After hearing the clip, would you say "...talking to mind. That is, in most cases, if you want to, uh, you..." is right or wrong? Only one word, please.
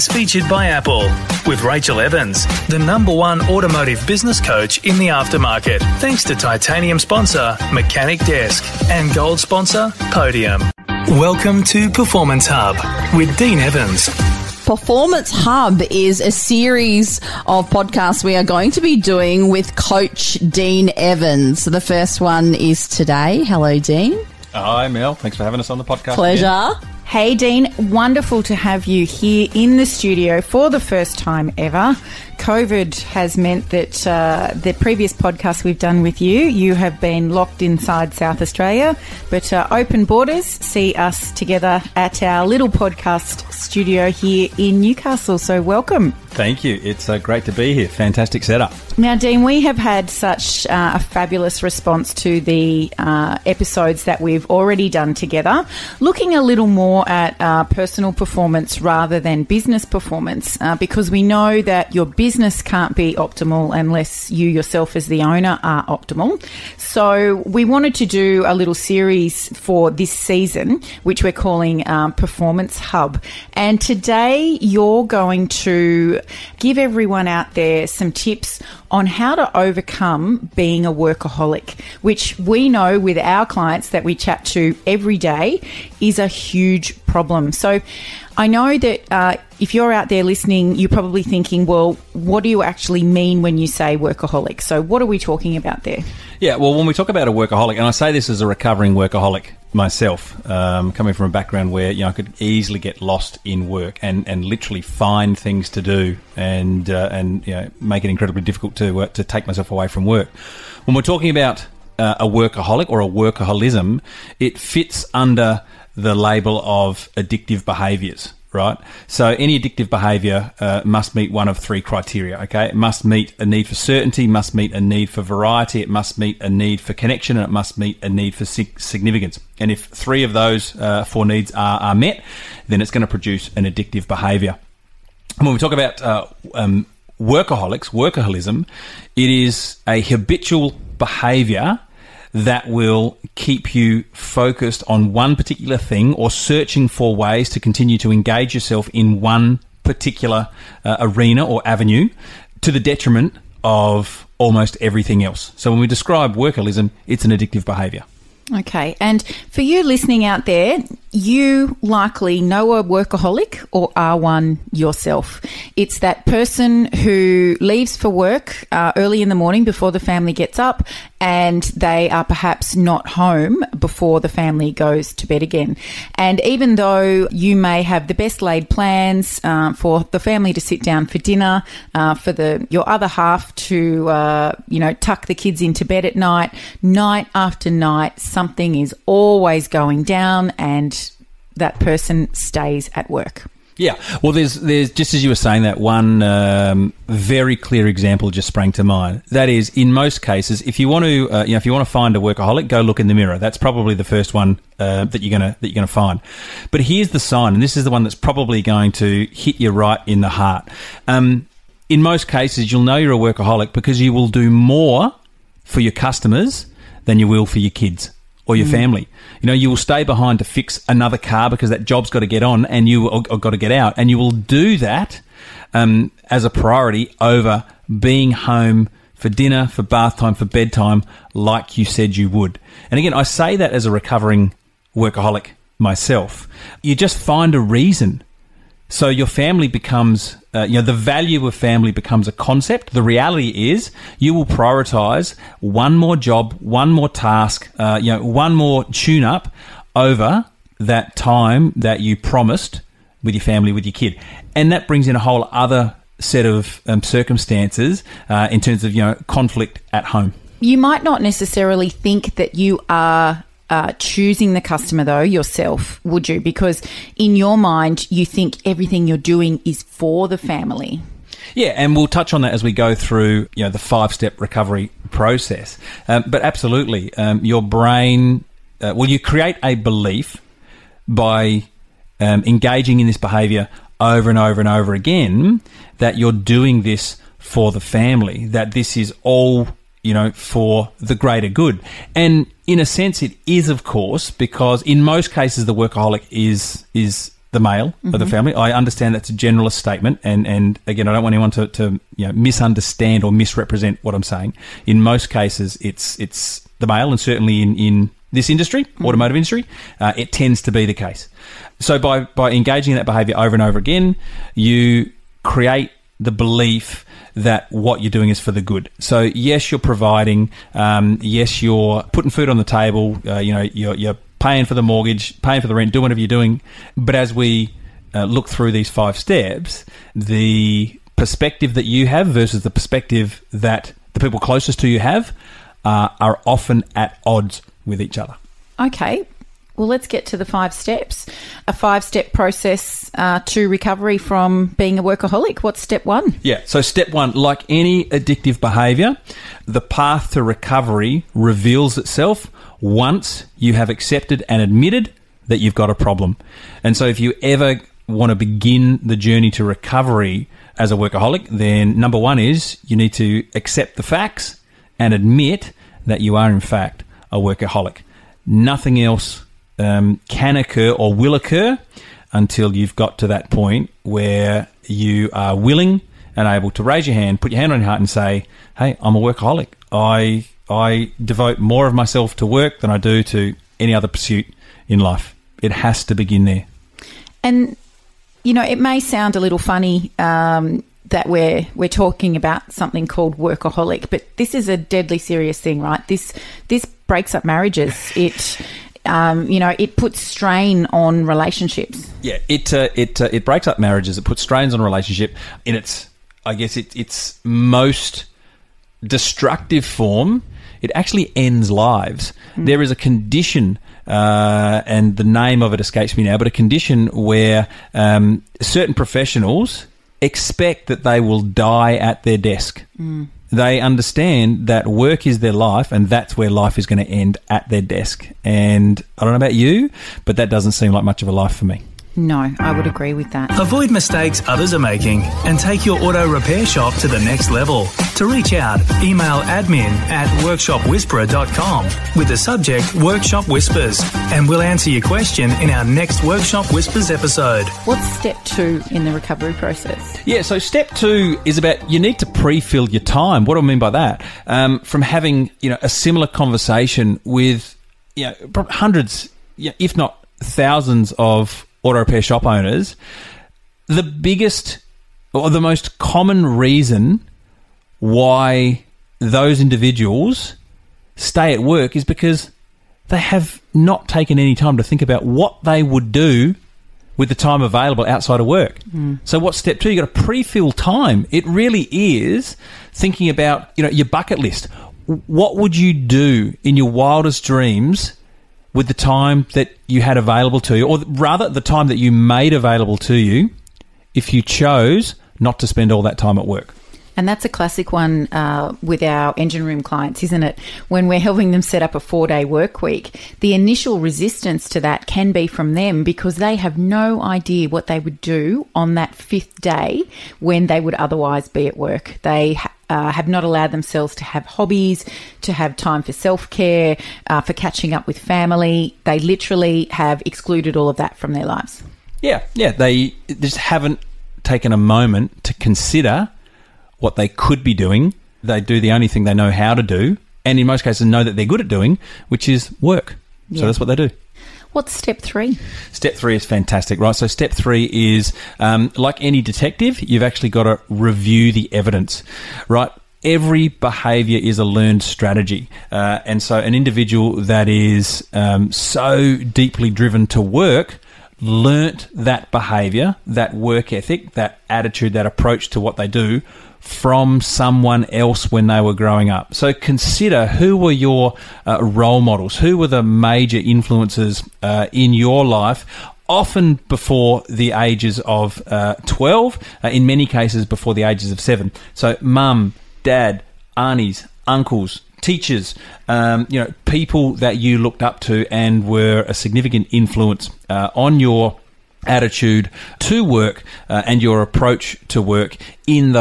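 wrong.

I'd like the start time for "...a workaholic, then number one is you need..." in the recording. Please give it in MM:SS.
06:00.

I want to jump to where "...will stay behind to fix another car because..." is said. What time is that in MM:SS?
03:39.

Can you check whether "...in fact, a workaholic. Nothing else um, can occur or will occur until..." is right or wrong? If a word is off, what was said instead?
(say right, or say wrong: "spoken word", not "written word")
right.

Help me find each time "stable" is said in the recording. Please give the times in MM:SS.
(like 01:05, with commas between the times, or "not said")
not said.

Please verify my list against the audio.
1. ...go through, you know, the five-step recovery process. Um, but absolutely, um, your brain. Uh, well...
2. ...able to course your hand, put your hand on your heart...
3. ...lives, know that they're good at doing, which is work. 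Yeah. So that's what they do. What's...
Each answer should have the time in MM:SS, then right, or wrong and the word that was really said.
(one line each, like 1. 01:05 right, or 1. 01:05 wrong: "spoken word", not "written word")
1. 04:32 right
2. 06:16 wrong: "raise", not "course"
3. 08:50 wrong: "cases", not "lives".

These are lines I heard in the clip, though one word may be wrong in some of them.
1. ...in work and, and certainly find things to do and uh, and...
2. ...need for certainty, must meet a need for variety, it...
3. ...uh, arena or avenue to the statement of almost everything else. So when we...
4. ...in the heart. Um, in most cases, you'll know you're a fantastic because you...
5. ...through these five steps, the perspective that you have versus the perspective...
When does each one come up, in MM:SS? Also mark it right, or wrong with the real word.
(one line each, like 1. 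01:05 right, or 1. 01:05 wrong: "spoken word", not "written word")
1. 01:43 wrong: "literally", not "certainly"
2. 02:03 right
3. 02:30 wrong: "detriment", not "statement"
4. 03:30 wrong: "workaholic", not "fantastic"
5. 05:28 right.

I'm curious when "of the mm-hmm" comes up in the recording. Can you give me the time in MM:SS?
04:58.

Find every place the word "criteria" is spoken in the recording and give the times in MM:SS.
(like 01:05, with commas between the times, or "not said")
02:01.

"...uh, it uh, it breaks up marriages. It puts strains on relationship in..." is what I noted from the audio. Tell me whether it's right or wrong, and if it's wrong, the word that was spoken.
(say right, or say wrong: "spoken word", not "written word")
right.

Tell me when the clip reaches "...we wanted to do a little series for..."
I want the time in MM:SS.
01:07.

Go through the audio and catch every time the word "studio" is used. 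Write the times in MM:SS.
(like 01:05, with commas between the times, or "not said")
00:29, 00:43.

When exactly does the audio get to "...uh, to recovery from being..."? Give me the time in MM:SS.
05:43.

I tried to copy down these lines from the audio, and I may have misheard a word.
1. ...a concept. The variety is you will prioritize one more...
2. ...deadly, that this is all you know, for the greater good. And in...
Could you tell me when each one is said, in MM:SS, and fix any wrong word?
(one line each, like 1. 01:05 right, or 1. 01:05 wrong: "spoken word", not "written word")
1. 04:02 wrong: "reality", not "variety"
2. 04:47 wrong: "family", not "deadly".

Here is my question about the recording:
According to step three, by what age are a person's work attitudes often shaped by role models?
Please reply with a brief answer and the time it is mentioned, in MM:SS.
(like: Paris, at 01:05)
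7, at 09:31.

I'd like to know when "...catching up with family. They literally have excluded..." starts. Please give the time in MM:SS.
08:37.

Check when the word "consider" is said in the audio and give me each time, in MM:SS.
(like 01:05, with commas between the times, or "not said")
08:45, 09:19.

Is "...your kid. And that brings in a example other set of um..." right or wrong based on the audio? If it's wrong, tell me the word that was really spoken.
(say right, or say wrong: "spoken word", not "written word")
wrong: "whole", not "example".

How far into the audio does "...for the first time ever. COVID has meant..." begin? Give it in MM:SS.
00:30.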